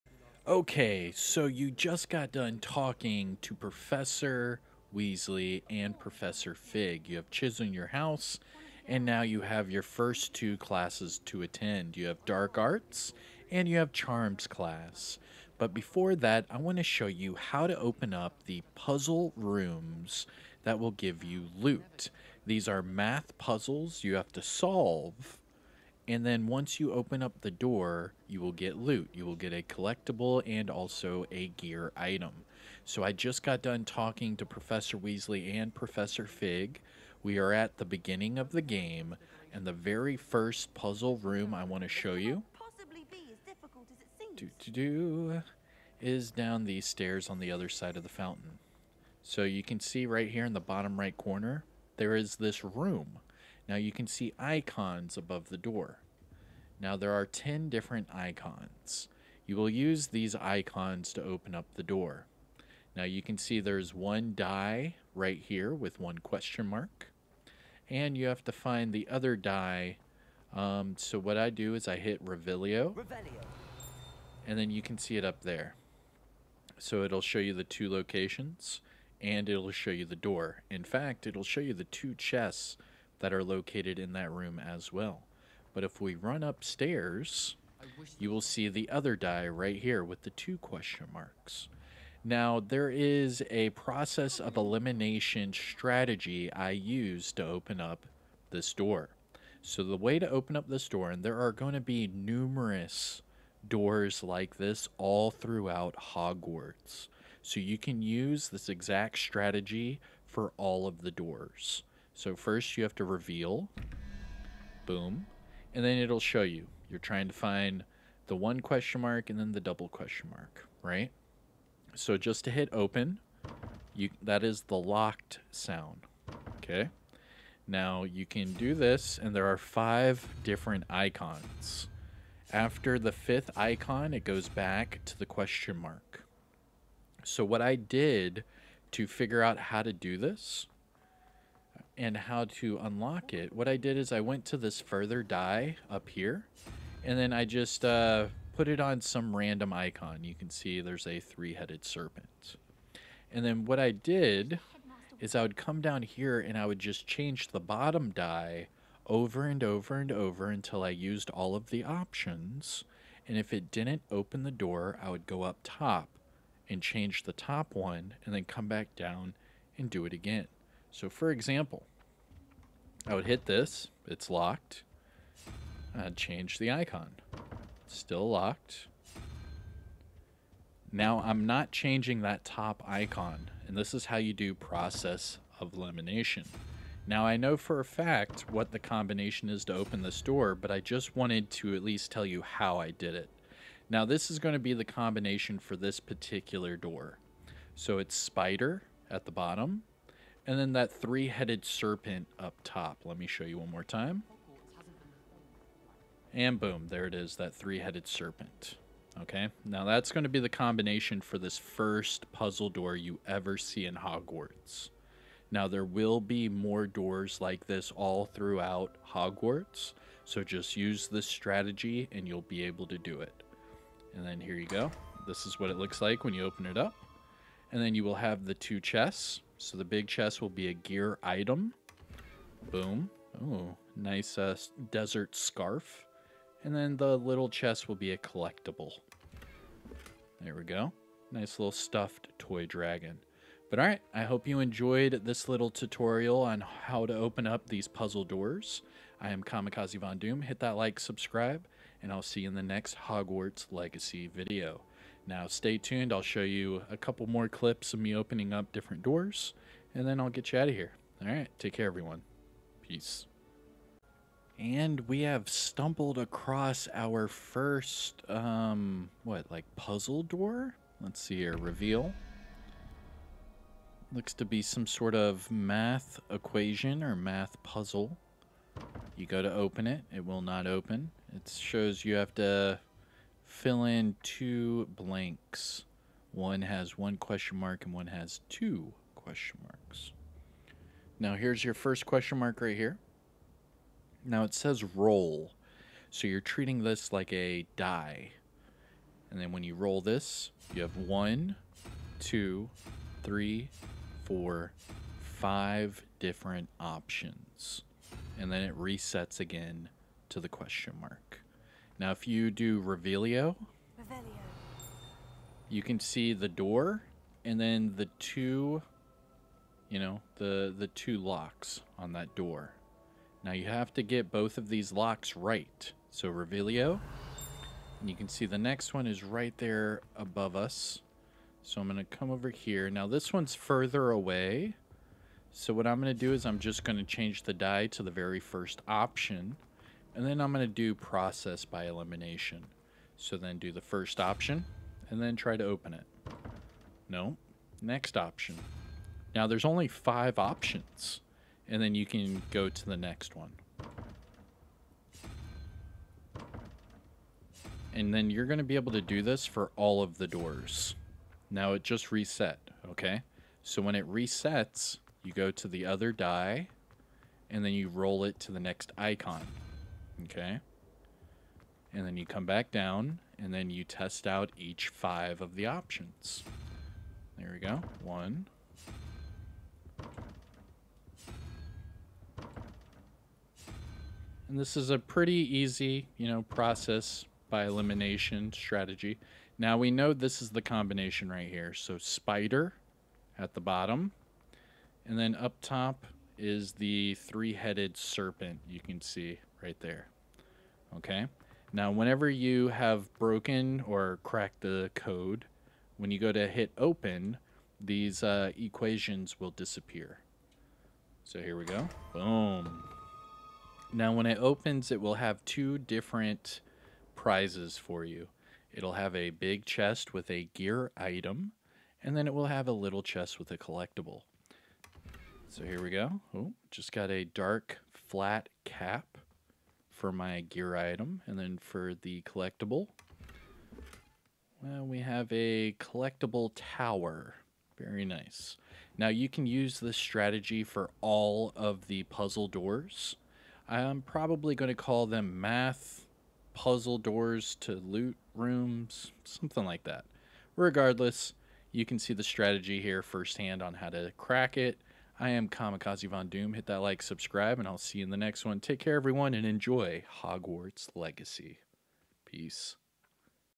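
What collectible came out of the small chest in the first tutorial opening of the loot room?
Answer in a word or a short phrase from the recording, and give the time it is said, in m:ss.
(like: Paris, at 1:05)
Stuffed toy dragon, at 4:01.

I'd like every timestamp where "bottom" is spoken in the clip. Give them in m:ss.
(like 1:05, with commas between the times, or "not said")
0:50, 2:37, 3:19, 6:33.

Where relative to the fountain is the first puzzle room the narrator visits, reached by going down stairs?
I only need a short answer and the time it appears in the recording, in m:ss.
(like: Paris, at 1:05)
Other side of the fountain, at 0:47.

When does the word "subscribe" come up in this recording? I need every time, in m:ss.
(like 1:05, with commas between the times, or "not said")
4:10, 7:37.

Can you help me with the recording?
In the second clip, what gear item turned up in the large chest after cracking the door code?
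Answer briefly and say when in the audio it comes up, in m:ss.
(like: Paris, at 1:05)
Dark flat cap, at 7:07.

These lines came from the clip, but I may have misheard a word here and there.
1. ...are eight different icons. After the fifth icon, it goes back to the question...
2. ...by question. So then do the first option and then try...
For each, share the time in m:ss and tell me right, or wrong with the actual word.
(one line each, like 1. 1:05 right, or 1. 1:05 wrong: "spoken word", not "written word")
1. 2:09 wrong: "five", not "eight"
2. 5:41 wrong: "elimination", not "question".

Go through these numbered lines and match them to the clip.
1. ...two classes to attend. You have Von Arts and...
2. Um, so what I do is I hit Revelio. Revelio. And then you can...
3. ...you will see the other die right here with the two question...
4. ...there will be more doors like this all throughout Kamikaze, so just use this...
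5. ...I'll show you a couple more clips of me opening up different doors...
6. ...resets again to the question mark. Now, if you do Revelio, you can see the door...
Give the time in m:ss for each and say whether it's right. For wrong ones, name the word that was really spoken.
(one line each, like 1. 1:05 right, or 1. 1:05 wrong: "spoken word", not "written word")
1. 0:10 wrong: "Dark", not "Von"
2. 1:10 right
3. 1:28 right
4. 3:35 wrong: "Hogwarts", not "Kamikaze"
5. 4:16 right
6. 5:08 right.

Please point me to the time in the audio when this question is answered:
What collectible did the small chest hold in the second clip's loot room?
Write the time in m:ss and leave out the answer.
7:15.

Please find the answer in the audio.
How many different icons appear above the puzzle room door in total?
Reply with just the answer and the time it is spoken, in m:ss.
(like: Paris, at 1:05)
10, at 0:57.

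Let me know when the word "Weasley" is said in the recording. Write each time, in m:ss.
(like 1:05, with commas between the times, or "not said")
0:04, 0:34.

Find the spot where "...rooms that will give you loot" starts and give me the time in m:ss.
0:19.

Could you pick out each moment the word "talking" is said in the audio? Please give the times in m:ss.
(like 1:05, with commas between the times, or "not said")
0:02, 0:33.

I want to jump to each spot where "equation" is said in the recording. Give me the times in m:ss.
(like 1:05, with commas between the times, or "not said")
4:36, 6:48.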